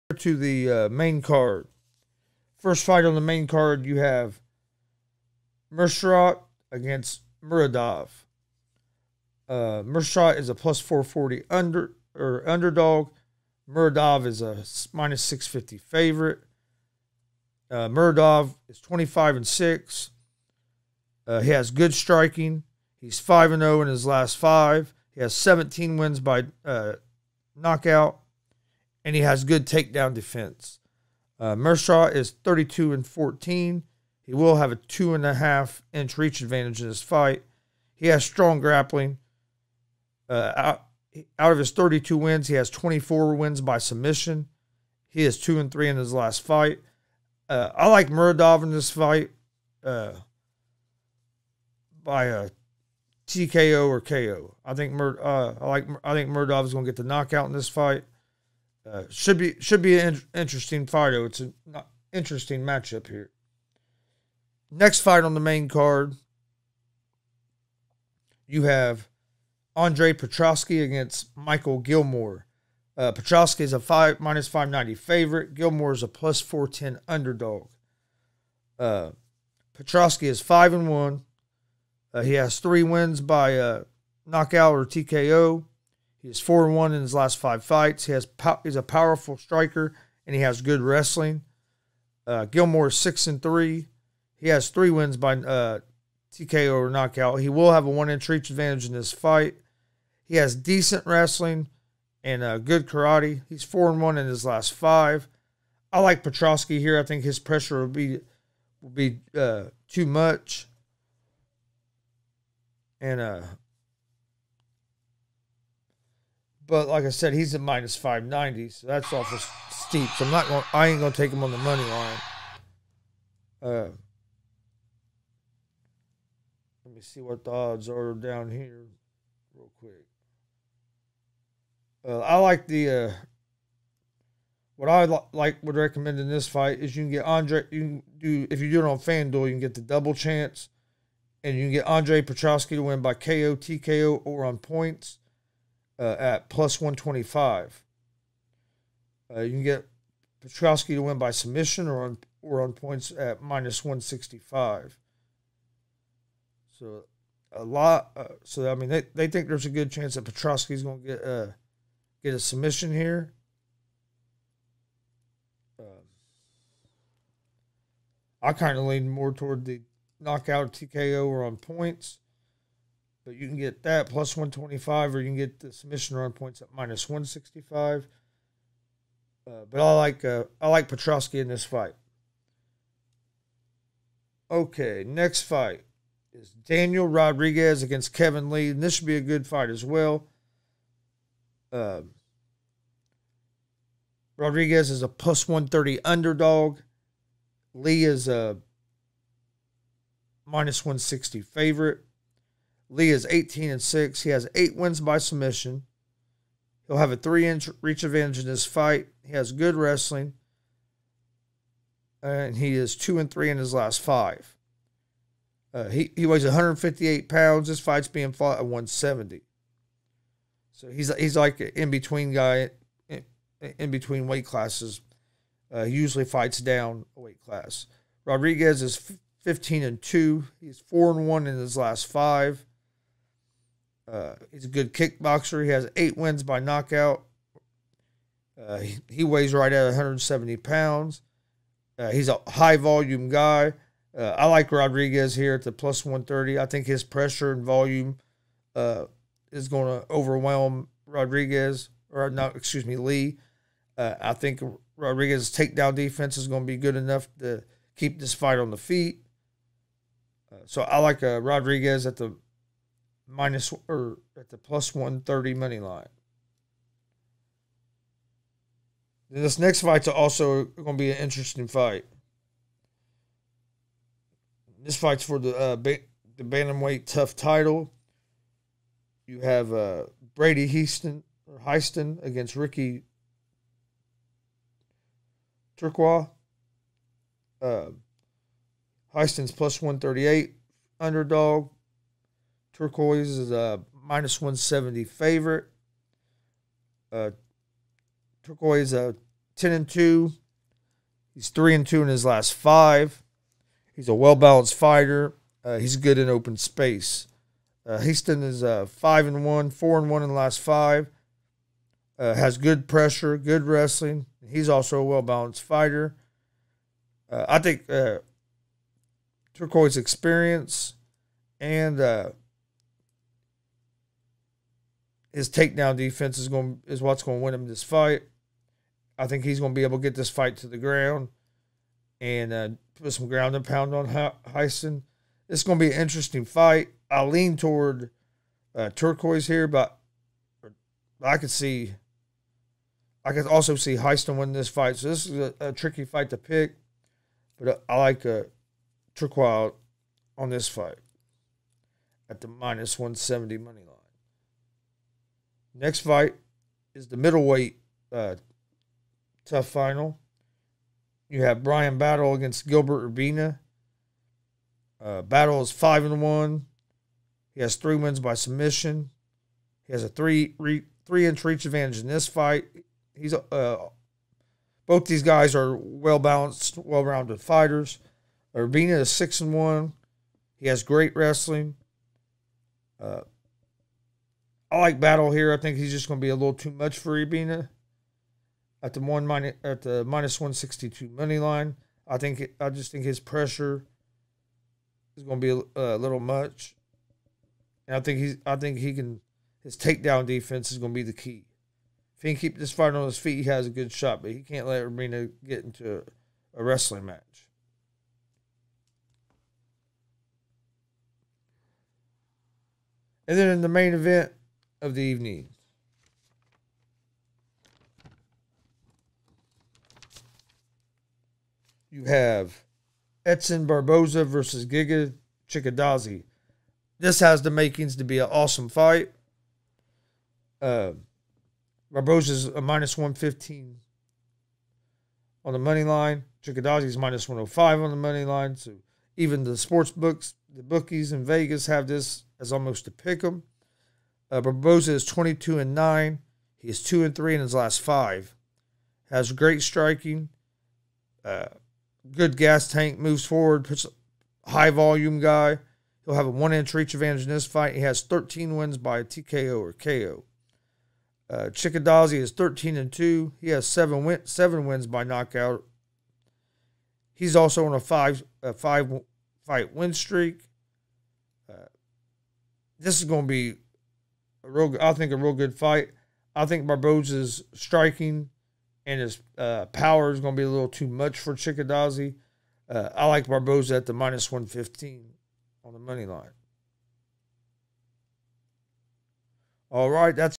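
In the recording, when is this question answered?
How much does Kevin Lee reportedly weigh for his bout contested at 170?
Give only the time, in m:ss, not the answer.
3:36.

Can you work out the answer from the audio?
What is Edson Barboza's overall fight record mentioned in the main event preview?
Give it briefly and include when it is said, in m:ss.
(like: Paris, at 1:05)
22-9, at 7:25.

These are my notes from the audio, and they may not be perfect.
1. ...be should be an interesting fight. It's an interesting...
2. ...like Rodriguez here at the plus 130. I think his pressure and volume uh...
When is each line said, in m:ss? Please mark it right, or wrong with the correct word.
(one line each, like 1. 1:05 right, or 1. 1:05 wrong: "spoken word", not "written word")
1. 0:59 right
2. 4:04 right.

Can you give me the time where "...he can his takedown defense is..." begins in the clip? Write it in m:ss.
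6:38.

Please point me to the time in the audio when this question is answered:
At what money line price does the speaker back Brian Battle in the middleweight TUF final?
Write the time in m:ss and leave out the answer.
6:30.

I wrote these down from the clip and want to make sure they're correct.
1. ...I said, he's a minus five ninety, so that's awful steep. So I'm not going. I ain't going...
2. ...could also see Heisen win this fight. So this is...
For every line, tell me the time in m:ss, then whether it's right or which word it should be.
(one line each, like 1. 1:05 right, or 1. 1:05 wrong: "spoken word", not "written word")
1. 1:57 right
2. 5:43 right.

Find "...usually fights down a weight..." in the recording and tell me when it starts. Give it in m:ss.
3:45.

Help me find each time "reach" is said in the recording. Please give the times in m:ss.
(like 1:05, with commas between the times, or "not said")
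0:36, 1:38, 3:27, 6:11, 7:36.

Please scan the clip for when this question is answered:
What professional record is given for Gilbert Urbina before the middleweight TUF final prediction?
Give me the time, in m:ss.
6:19.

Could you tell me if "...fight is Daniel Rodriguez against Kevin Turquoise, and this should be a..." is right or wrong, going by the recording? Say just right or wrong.
wrong.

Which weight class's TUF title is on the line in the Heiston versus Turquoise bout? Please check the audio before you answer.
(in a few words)
Bantamweight.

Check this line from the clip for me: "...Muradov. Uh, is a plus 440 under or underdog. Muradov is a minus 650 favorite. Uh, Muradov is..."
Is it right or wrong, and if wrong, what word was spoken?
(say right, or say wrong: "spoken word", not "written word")
right.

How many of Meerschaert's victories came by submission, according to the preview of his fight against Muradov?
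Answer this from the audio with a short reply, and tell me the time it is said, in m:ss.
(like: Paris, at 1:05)
24, at 0:42.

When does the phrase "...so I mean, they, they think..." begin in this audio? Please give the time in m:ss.
2:38.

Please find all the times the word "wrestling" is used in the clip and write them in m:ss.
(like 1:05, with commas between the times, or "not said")
1:30, 1:41, 3:29, 5:13, 6:21, 6:46.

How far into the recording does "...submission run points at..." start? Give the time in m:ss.
2:55.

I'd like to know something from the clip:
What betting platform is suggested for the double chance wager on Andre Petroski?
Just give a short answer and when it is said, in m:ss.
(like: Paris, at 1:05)
FanDuel, at 2:18.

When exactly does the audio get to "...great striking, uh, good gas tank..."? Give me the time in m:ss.
7:29.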